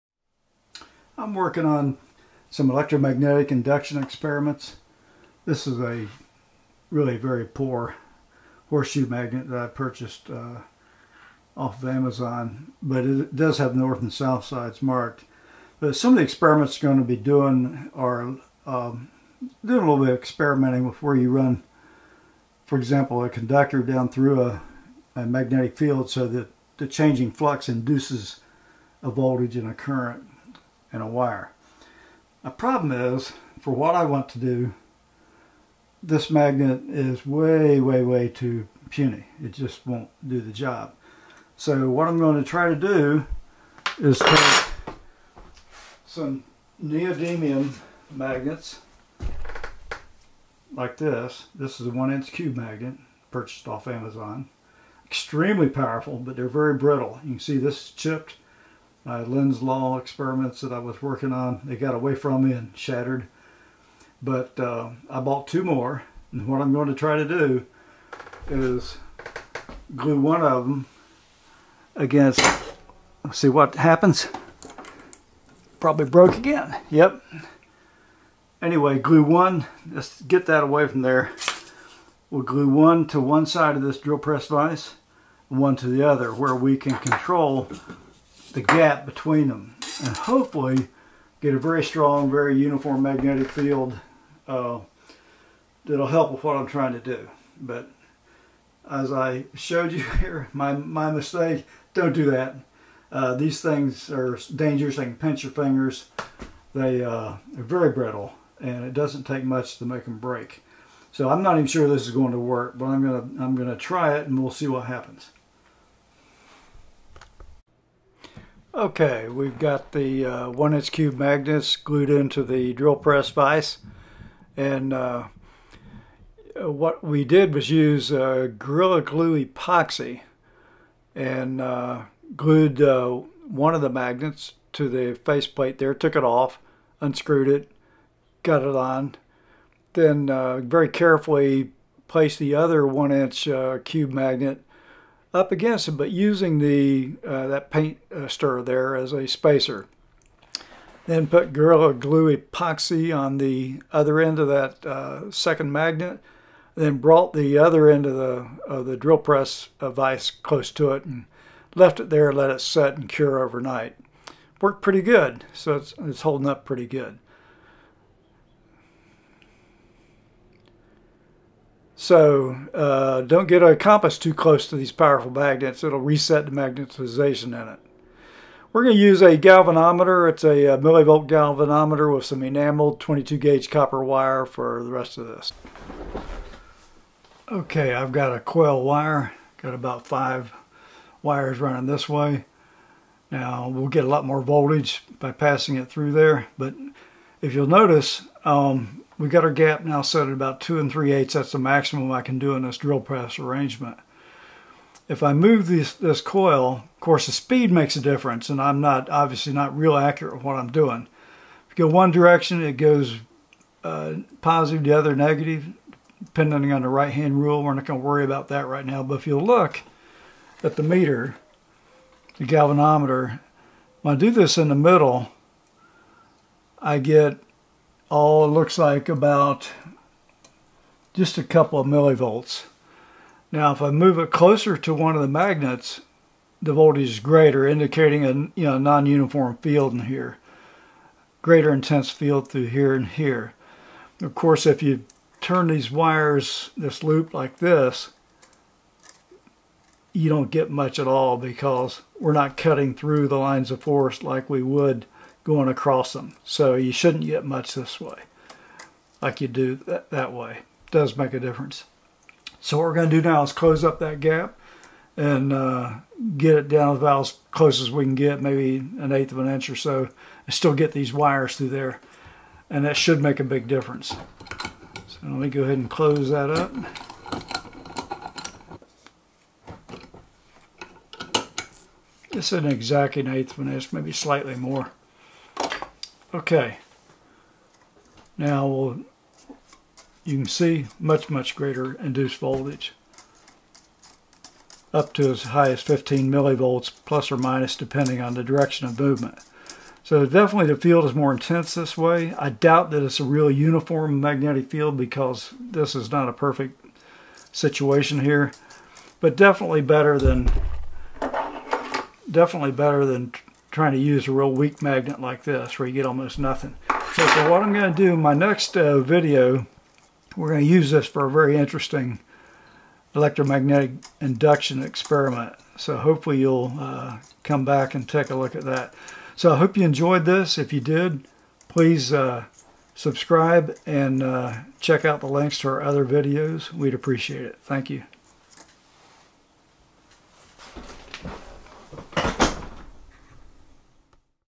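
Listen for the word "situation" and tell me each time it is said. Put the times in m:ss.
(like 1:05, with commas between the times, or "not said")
5:07.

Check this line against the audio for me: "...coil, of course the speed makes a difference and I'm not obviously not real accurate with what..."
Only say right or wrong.
right.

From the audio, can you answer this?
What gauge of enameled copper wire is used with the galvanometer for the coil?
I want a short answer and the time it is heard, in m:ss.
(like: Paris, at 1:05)
22, at 3:03.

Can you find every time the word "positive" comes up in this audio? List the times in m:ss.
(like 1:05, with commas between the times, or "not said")
3:34.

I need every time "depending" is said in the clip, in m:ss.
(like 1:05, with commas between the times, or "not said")
3:36, 4:57.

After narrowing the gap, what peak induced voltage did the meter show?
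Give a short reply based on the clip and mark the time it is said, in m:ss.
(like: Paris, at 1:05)
15 millivolts, at 4:55.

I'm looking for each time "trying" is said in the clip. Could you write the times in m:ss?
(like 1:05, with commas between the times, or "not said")
1:36, 5:13.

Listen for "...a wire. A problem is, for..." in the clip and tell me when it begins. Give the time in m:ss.
0:31.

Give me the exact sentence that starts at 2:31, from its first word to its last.
Then put Gorilla Glue epoxy on the other end of that uh, second magnet.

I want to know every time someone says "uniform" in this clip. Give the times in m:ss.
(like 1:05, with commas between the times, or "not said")
1:32, 3:58, 5:03.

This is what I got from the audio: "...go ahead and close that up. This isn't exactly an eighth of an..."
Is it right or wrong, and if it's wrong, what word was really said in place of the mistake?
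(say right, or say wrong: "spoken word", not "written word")
right.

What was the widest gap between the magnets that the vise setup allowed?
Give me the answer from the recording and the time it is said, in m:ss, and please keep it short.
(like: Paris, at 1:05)
2 and 3/8, at 3:20.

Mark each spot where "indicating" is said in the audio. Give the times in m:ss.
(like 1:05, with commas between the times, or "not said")
3:57.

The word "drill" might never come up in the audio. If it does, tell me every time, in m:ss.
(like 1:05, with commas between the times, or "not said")
1:23, 2:02, 2:38, 3:22.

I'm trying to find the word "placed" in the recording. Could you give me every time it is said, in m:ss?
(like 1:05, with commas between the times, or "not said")
2:22.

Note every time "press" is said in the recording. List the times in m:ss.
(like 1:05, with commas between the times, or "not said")
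1:24, 2:02, 2:39, 3:23.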